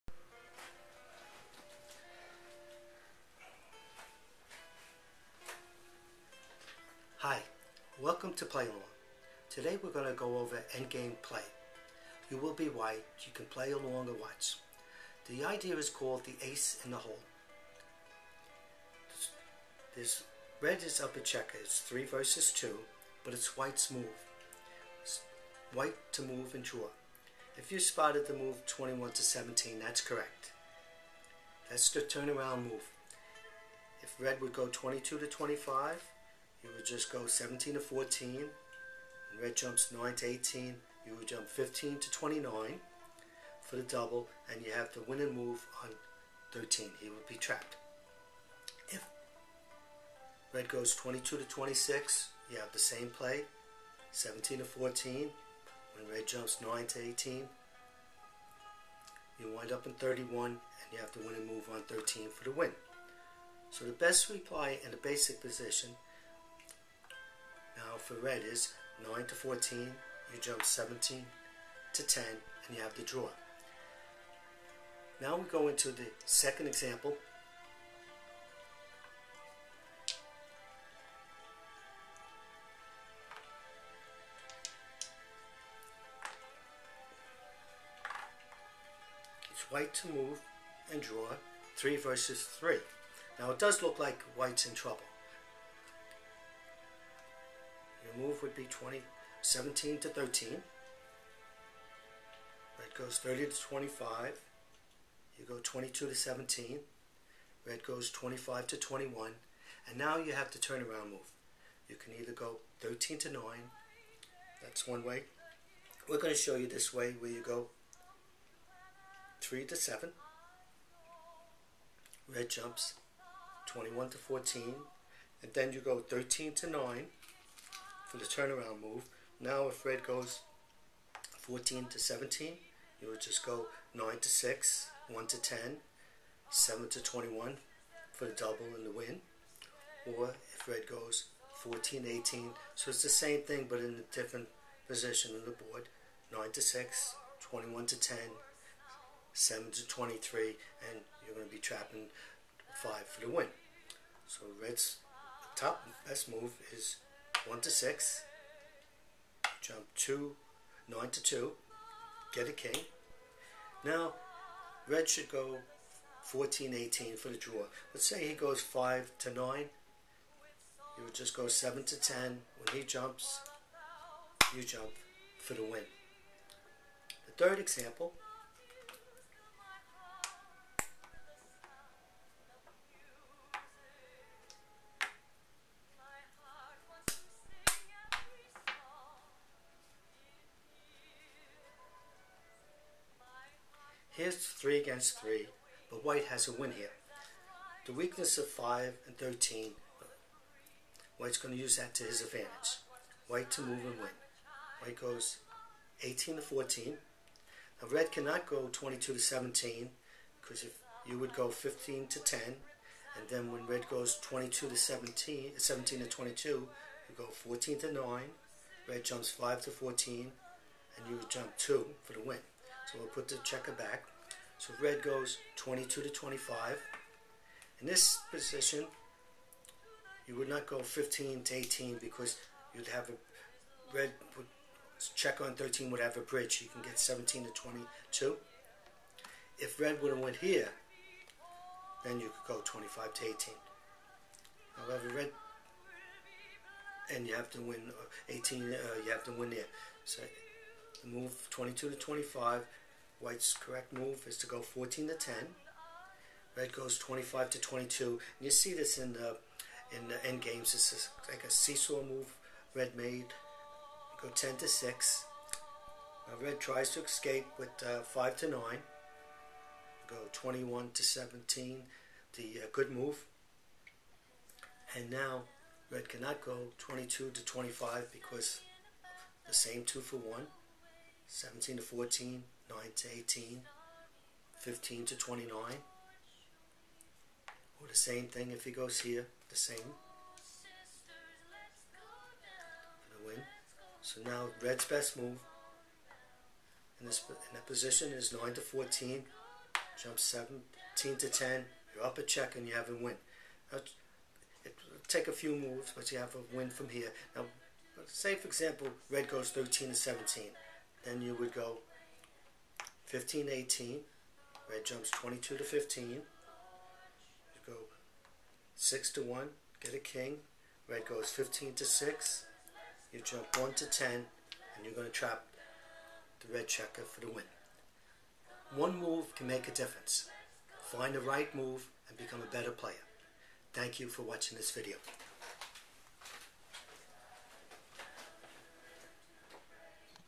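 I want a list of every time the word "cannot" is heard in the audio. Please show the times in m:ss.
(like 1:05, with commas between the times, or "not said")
3:28, 4:36.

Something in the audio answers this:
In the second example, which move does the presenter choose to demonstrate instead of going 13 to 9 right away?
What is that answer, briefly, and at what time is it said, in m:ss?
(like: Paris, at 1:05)
3 to 7, at 1:59.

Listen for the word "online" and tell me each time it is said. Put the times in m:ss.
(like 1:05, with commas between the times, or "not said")
not said.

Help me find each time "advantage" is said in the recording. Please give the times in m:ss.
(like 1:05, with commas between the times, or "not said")
3:22.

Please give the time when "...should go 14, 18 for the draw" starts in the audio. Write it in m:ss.
2:45.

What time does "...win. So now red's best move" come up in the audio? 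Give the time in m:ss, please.
4:53.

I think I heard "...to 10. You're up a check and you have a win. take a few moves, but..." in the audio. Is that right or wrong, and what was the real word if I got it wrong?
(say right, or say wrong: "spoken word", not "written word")
right.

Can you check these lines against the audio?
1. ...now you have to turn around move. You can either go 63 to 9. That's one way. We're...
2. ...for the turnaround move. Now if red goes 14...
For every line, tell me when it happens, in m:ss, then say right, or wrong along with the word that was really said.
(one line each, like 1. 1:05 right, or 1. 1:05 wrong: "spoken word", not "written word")
1. 1:49 wrong: "13", not "63"
2. 2:08 right.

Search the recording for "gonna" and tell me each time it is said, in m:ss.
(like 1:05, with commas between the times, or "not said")
3:21.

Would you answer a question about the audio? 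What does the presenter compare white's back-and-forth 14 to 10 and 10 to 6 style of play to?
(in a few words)
A seesaw move.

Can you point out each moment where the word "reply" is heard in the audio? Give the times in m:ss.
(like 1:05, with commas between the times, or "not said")
1:04.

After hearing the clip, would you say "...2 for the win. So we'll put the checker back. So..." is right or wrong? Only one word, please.
right.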